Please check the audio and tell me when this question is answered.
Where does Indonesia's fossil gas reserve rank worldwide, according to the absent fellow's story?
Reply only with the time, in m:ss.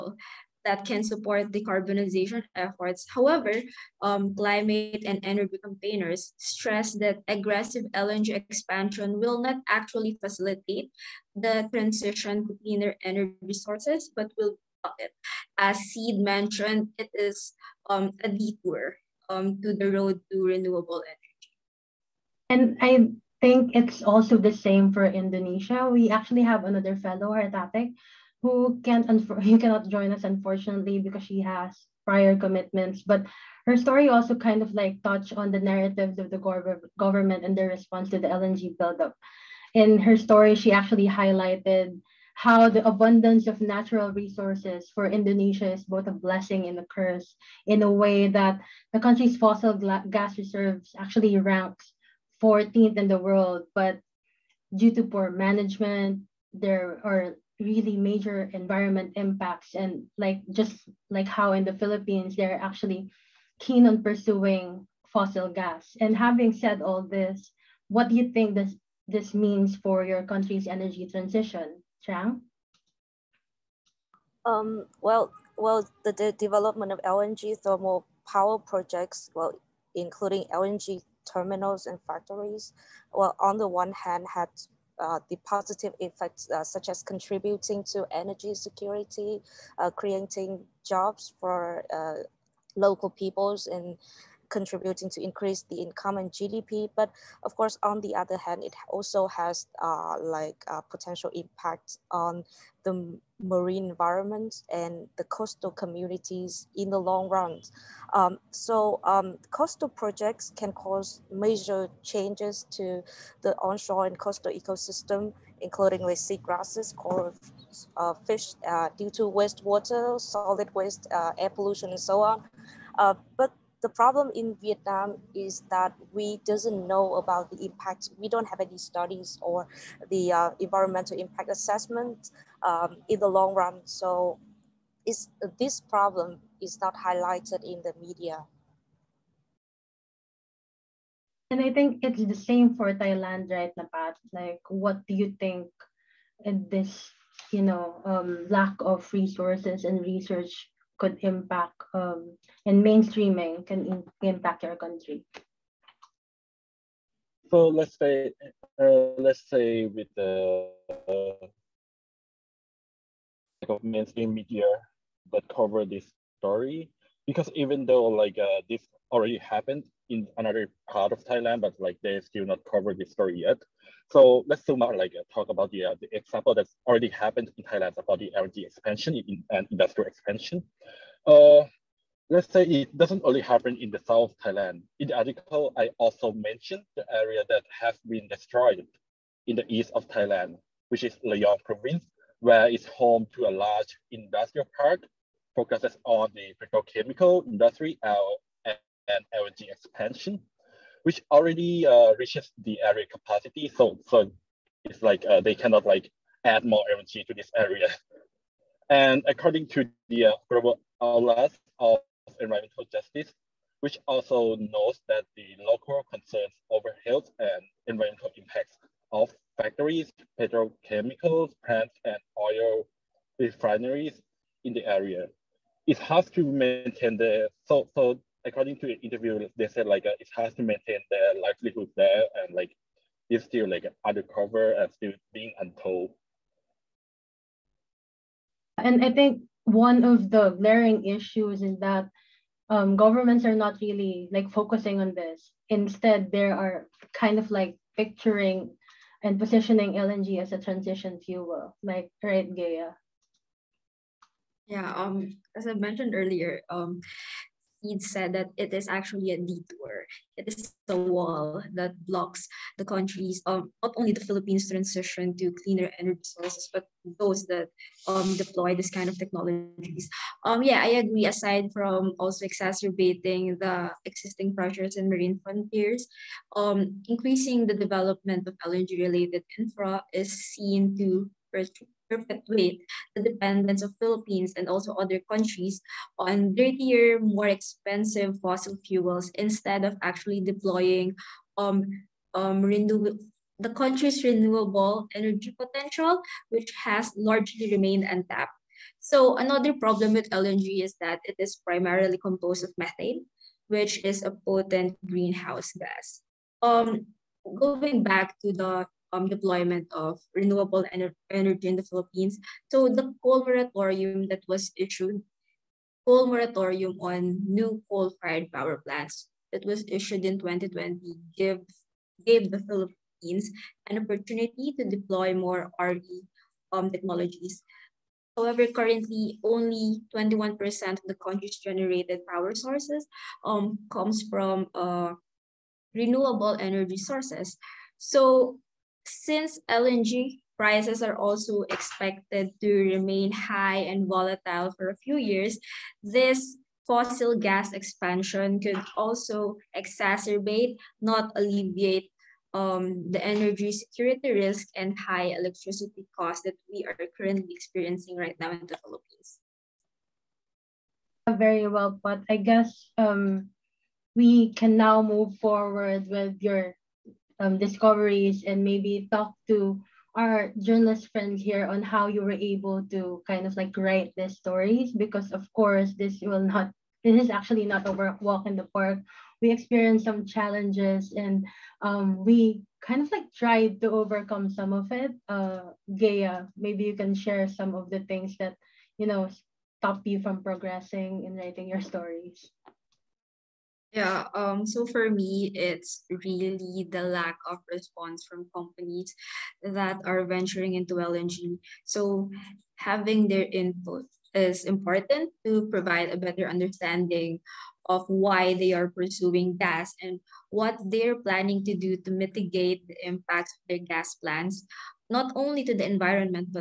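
0:52.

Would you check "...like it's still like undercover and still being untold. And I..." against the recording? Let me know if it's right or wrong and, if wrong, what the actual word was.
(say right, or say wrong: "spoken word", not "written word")
right.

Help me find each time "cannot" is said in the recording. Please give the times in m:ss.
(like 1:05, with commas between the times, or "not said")
0:29, 3:25.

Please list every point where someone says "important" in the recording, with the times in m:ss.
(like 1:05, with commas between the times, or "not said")
6:44.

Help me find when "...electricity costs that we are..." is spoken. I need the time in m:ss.
5:55.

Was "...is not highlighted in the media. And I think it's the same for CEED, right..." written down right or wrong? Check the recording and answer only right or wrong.
wrong.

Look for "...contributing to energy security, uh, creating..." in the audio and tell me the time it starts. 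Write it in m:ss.
1:27.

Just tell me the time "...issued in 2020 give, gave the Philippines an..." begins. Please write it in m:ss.
5:19.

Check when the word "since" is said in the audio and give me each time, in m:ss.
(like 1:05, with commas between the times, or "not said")
5:39.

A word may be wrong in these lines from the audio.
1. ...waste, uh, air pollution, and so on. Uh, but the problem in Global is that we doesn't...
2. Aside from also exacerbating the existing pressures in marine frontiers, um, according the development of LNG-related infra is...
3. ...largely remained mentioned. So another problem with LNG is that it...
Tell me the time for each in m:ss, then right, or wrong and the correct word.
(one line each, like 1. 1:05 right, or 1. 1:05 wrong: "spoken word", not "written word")
1. 2:00 wrong: "Vietnam", not "Global"
2. 4:31 wrong: "increasing", not "according"
3. 4:57 wrong: "untapped", not "mentioned".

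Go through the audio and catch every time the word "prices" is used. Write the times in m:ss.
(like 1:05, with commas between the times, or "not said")
5:40.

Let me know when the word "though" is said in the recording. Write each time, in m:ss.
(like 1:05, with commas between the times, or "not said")
2:47.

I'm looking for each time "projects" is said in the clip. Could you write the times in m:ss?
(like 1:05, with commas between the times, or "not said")
1:18, 1:49.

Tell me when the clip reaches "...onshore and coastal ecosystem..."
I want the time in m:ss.
1:53.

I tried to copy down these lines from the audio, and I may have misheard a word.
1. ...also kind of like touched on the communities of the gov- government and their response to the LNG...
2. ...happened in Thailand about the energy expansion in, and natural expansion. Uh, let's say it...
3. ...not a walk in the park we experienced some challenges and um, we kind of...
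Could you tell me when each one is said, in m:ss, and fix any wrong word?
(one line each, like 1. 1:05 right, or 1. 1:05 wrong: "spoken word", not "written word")
1. 0:34 wrong: "narratives", not "communities"
2. 2:57 wrong: "industrial", not "natural"
3. 6:17 right.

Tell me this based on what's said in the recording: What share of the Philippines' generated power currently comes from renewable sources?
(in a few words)
21%.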